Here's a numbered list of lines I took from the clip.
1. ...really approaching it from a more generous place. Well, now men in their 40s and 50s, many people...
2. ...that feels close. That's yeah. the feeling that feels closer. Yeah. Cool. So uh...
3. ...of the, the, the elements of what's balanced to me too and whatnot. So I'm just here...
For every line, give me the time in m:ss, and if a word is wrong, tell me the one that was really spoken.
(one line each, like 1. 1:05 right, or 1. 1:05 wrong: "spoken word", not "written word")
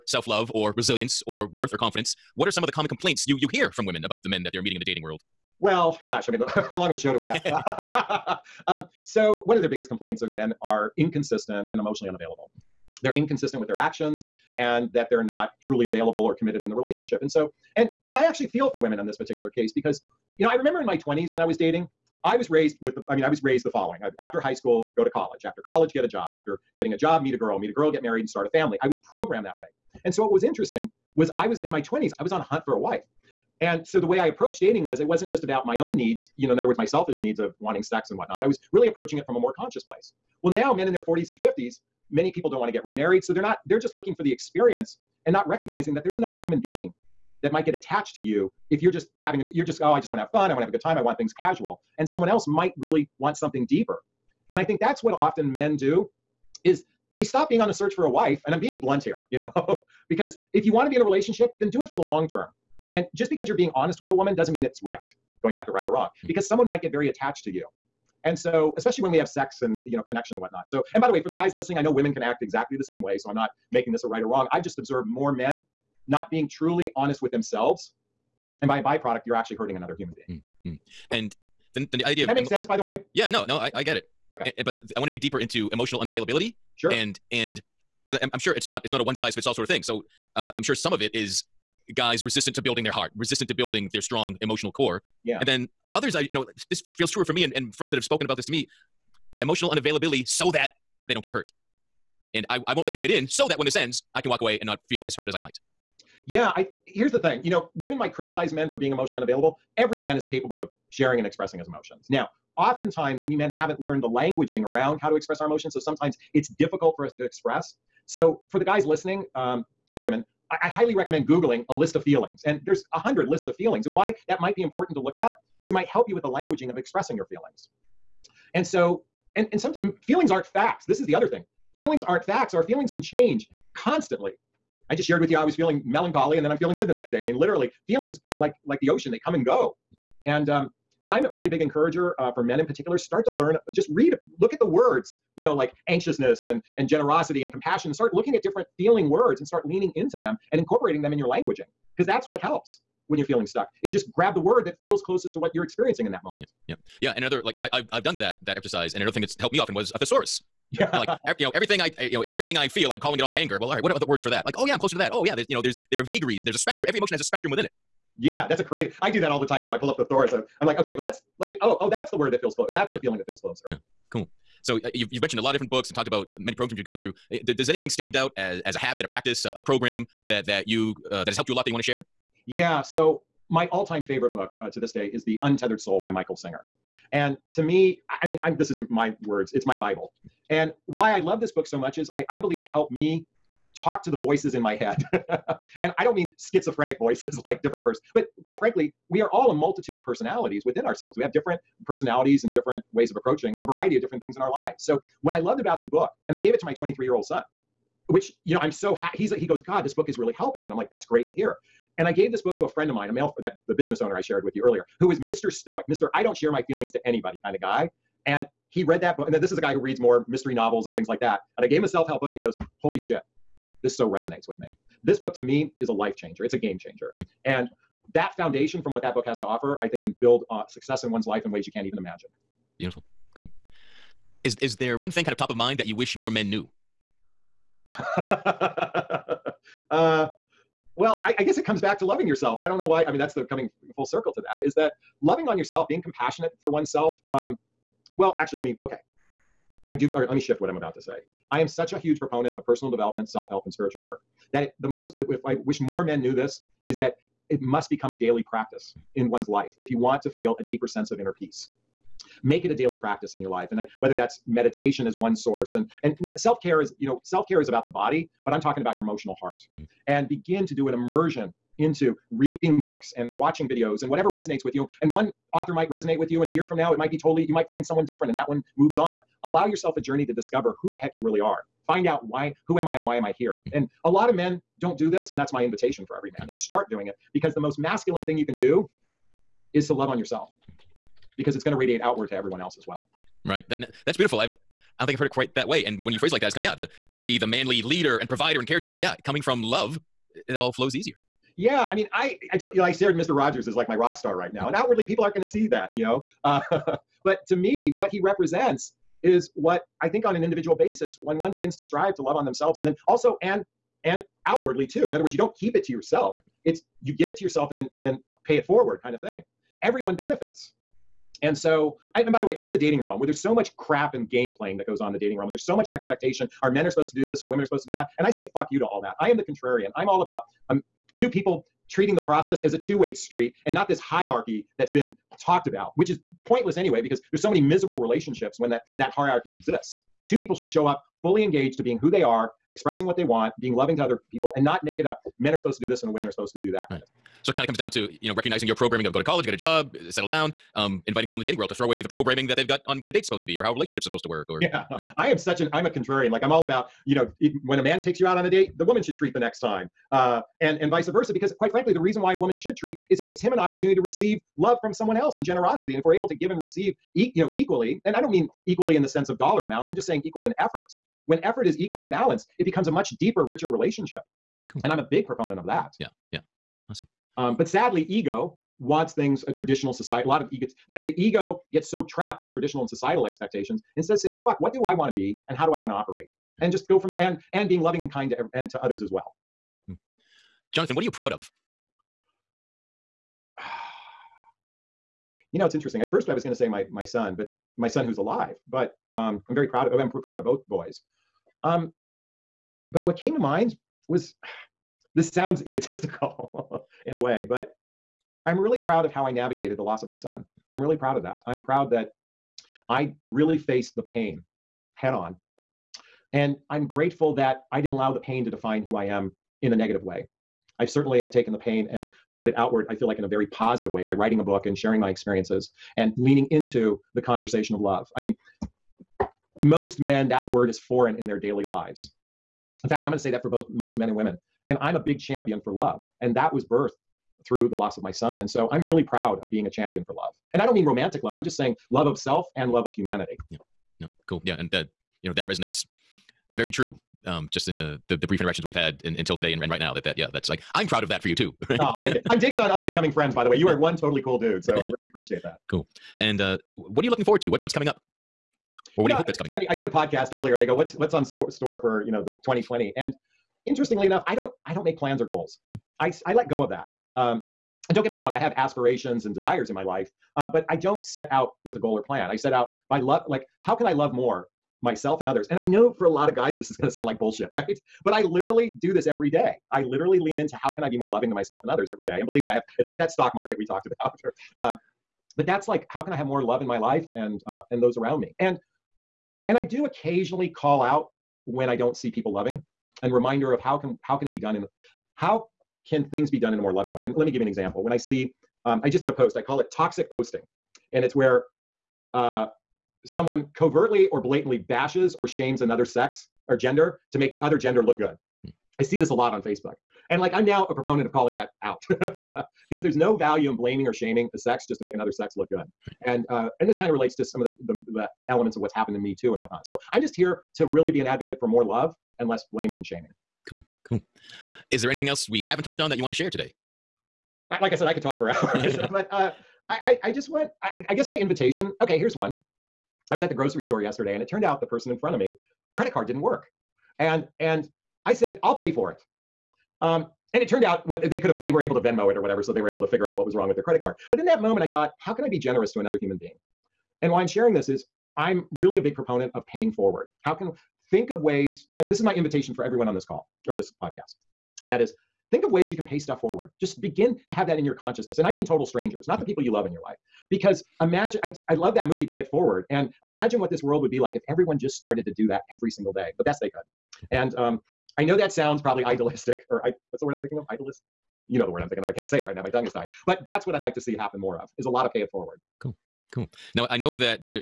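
1. 0:38 wrong: "conscious", not "generous"
2. 2:52 right
3. 8:37 wrong: "happened", not "balanced".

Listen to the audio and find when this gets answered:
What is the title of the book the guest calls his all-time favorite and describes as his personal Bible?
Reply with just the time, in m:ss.
3:05.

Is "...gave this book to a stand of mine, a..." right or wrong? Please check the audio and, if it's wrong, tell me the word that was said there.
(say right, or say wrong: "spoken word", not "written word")
wrong: "friend", not "stand".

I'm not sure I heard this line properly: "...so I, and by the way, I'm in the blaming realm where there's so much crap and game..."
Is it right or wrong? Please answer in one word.
wrong.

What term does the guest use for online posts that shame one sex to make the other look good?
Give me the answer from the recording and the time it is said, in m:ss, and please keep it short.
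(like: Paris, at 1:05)
Toxic posting, at 8:19.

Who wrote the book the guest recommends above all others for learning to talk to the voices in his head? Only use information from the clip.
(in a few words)
Michael Singer.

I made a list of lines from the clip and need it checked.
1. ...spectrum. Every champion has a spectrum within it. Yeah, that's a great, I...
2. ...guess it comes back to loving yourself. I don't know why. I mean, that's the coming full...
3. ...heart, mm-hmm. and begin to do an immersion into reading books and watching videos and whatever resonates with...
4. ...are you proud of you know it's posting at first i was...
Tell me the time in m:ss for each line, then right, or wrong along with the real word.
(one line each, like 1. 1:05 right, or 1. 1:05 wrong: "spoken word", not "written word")
1. 2:46 wrong: "emotion", not "champion"
2. 4:01 right
3. 4:29 right
4. 6:31 wrong: "interesting", not "posting".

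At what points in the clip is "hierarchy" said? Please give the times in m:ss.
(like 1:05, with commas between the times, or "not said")
5:33, 5:39.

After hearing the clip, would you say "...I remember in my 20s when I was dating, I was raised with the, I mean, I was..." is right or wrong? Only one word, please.
right.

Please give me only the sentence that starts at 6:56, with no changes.
And I'm grateful that I didn't allow the pain to define who I am in a negative way.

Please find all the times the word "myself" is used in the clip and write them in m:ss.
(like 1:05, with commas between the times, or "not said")
7:54, 8:01.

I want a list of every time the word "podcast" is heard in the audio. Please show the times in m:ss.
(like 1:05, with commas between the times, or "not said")
7:39, 9:13.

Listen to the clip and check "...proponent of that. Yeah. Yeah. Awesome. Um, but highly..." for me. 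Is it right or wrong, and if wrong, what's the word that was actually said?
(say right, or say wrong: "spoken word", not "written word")
wrong: "sadly", not "highly".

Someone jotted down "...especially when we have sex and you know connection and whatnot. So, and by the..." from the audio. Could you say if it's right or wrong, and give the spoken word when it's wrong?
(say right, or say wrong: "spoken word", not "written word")
right.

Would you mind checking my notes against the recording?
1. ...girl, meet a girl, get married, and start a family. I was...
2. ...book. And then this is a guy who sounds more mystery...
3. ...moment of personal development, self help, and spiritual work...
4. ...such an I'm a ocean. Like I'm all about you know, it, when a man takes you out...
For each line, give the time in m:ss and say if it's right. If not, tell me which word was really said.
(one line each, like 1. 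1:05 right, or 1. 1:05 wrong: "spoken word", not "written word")
1. 0:27 right
2. 3:39 wrong: "reads", not "sounds"
3. 4:12 wrong: "proponent", not "moment"
4. 5:55 wrong: "contrarian", not "ocean".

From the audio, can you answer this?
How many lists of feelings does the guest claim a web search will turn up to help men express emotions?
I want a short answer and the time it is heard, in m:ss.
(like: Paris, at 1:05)
100, at 2:02.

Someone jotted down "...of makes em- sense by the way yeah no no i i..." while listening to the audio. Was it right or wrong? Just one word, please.
right.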